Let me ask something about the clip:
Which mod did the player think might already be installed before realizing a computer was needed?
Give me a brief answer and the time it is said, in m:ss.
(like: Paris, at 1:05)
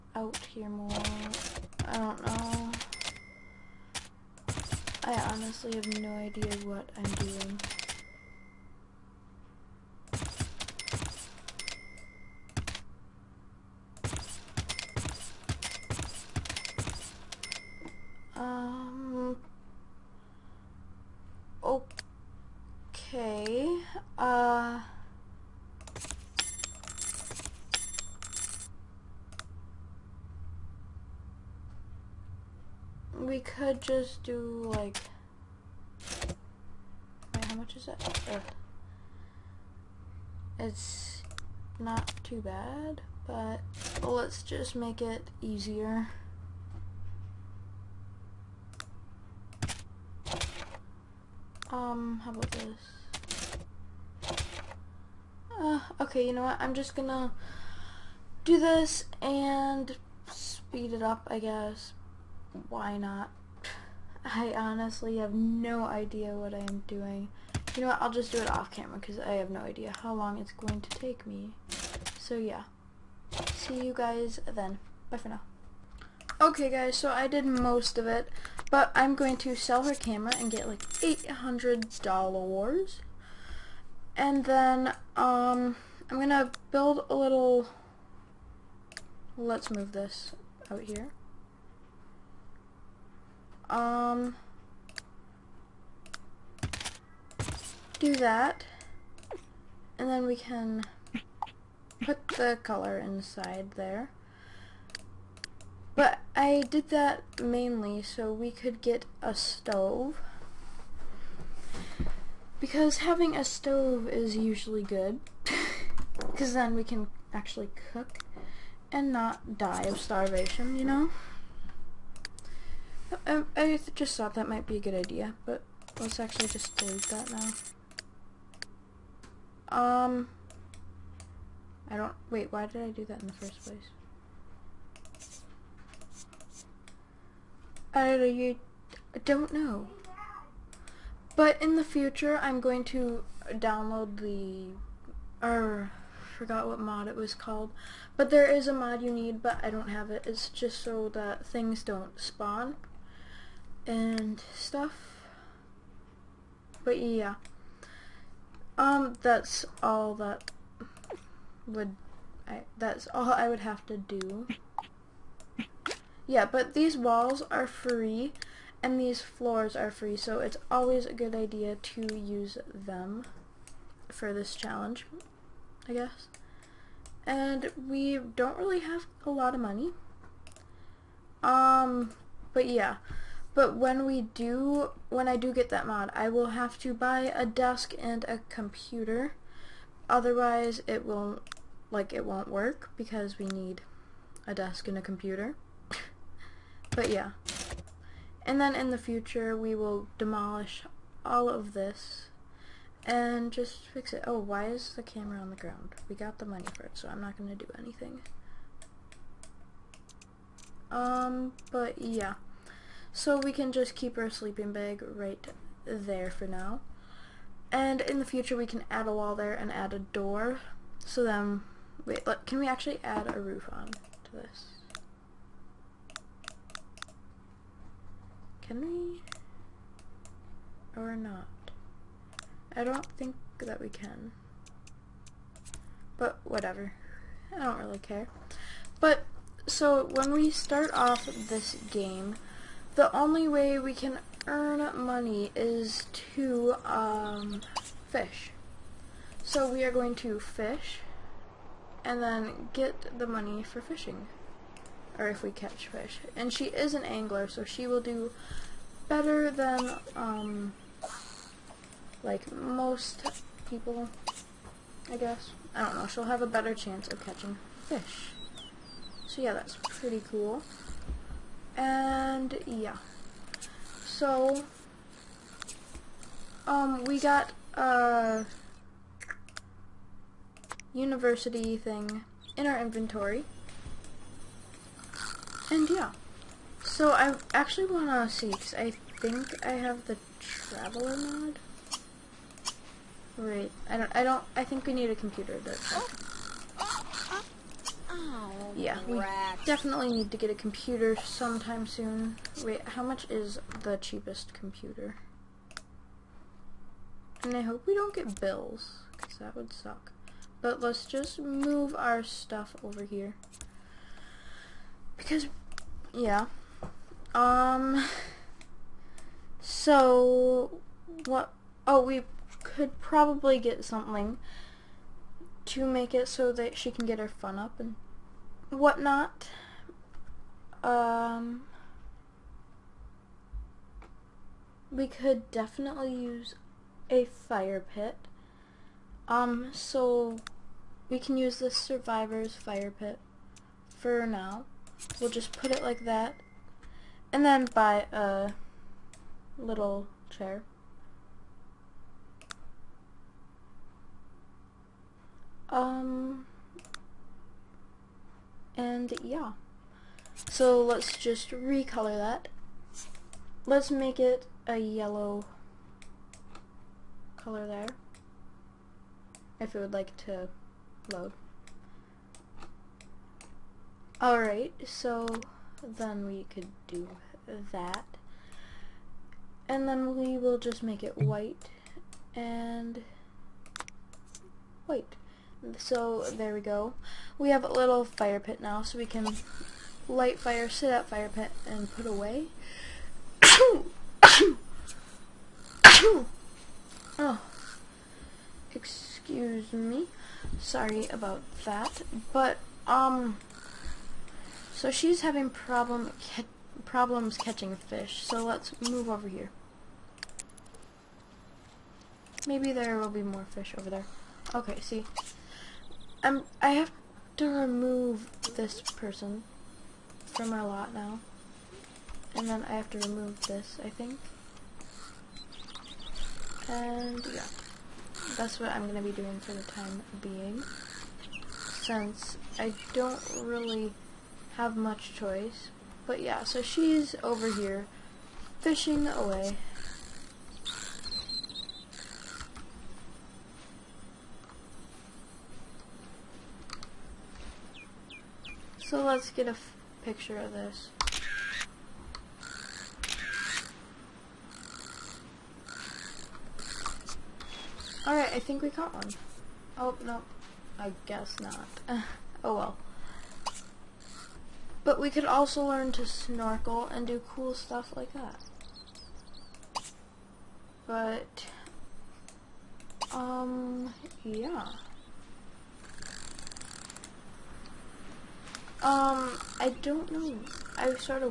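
traveler mod, at 4:50.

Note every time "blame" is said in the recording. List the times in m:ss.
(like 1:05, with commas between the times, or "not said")
not said.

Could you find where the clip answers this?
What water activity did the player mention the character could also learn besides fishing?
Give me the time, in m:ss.
7:46.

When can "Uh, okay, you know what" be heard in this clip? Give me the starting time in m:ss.
0:55.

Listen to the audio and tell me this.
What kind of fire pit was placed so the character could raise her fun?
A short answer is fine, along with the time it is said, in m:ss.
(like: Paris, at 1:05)
survivor's fire pit, at 5:41.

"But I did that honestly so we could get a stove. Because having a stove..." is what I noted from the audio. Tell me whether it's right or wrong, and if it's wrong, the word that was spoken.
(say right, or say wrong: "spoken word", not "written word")
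wrong: "mainly", not "honestly".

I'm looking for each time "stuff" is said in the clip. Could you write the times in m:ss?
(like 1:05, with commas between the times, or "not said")
2:34, 5:12, 7:47.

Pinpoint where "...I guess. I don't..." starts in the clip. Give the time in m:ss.
4:25.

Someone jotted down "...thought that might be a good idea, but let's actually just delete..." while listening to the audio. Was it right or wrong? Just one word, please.
right.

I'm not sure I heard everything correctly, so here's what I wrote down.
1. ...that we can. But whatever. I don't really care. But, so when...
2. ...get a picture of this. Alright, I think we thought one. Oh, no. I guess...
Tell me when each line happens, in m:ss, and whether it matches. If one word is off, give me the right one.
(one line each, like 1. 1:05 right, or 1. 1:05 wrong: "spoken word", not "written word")
1. 3:53 right
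2. 7:29 wrong: "caught", not "thought".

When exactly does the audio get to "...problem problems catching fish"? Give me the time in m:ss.
6:45.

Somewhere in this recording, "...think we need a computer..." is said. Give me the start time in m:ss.
4:54.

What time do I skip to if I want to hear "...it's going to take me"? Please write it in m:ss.
1:10.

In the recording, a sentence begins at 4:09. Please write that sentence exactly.
So we are going to fish and then get the money for fishing.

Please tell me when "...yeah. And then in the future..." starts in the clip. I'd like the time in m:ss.
3:17.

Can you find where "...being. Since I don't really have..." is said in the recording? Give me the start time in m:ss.
7:10.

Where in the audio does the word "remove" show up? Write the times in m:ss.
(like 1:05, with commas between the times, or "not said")
6:57, 7:02.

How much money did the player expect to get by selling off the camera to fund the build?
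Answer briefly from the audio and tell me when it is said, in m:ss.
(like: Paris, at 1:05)
$800, at 1:20.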